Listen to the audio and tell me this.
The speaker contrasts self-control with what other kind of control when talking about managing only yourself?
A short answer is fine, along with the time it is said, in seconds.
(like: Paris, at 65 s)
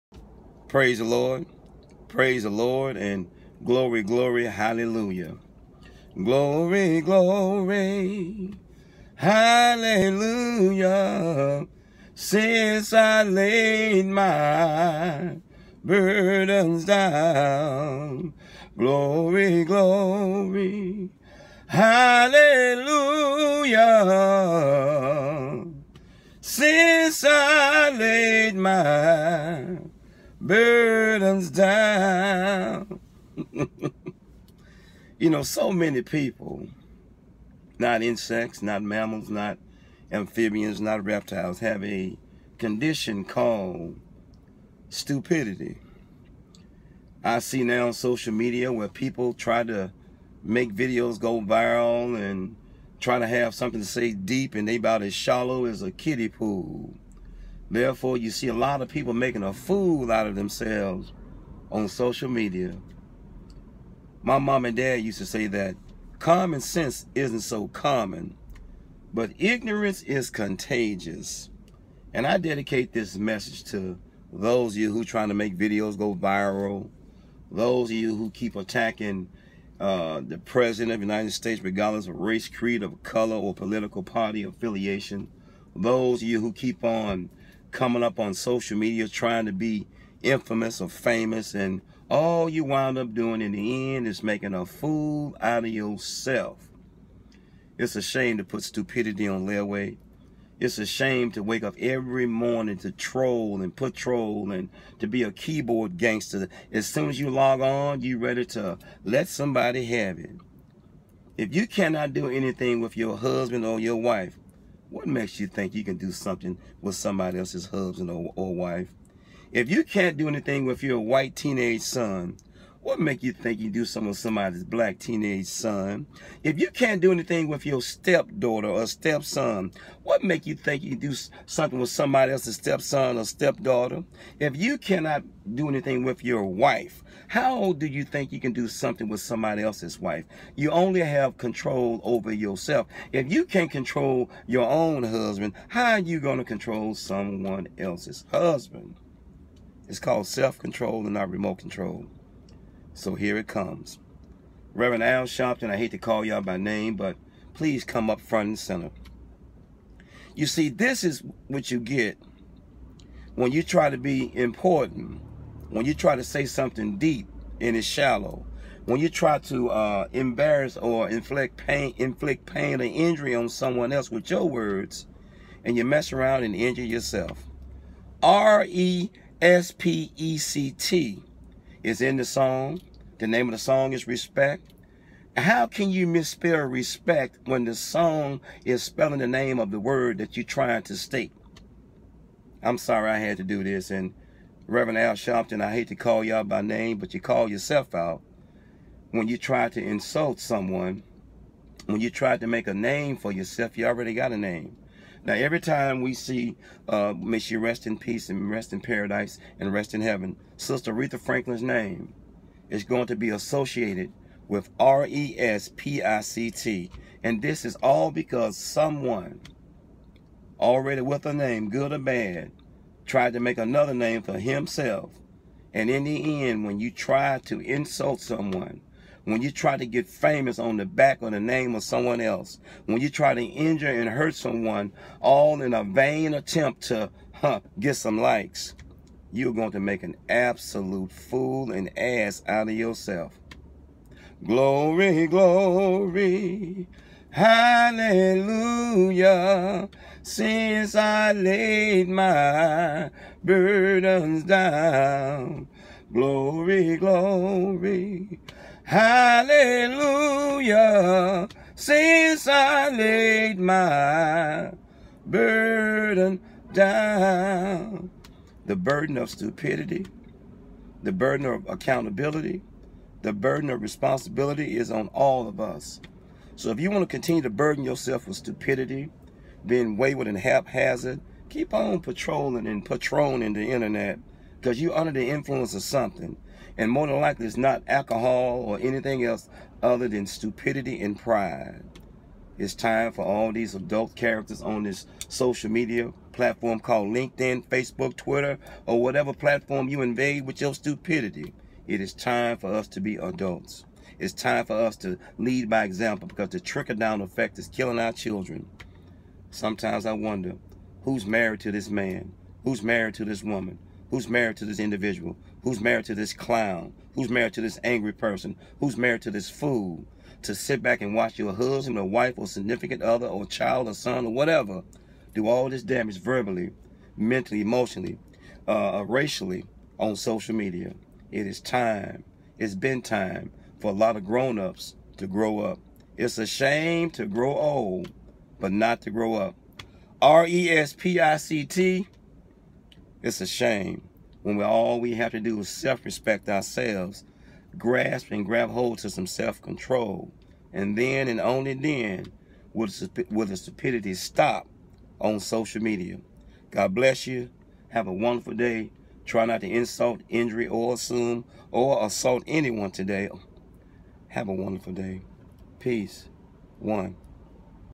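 remote control, at 151 s.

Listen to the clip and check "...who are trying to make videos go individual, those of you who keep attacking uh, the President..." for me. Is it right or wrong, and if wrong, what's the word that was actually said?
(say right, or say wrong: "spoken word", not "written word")
wrong: "viral", not "individual".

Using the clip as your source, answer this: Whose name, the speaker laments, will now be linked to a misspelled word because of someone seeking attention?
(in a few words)
Aretha Franklin.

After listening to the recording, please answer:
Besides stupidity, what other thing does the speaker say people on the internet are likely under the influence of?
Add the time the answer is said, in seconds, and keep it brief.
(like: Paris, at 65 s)
pride, at 291 s.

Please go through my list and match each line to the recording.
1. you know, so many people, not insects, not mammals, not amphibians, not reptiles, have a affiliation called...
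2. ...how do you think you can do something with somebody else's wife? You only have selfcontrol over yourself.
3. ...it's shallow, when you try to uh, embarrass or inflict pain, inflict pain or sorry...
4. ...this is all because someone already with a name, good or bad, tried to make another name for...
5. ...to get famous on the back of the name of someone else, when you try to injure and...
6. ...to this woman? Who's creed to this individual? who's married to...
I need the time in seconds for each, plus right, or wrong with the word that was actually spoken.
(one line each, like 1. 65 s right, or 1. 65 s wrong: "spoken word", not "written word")
1. 35 s wrong: "condition", not "affiliation"
2. 137 s wrong: "control", not "selfcontrol"
3. 167 s wrong: "injury", not "sorry"
4. 217 s right
5. 229 s right
6. 313 s wrong: "married", not "creed".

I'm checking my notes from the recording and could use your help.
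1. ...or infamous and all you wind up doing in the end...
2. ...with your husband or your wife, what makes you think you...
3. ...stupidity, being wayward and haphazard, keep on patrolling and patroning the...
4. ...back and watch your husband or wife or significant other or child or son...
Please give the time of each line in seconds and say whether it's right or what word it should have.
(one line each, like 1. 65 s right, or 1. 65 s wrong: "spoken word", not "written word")
1. 90 s wrong: "famous", not "infamous"
2. 112 s right
3. 278 s right
4. 320 s right.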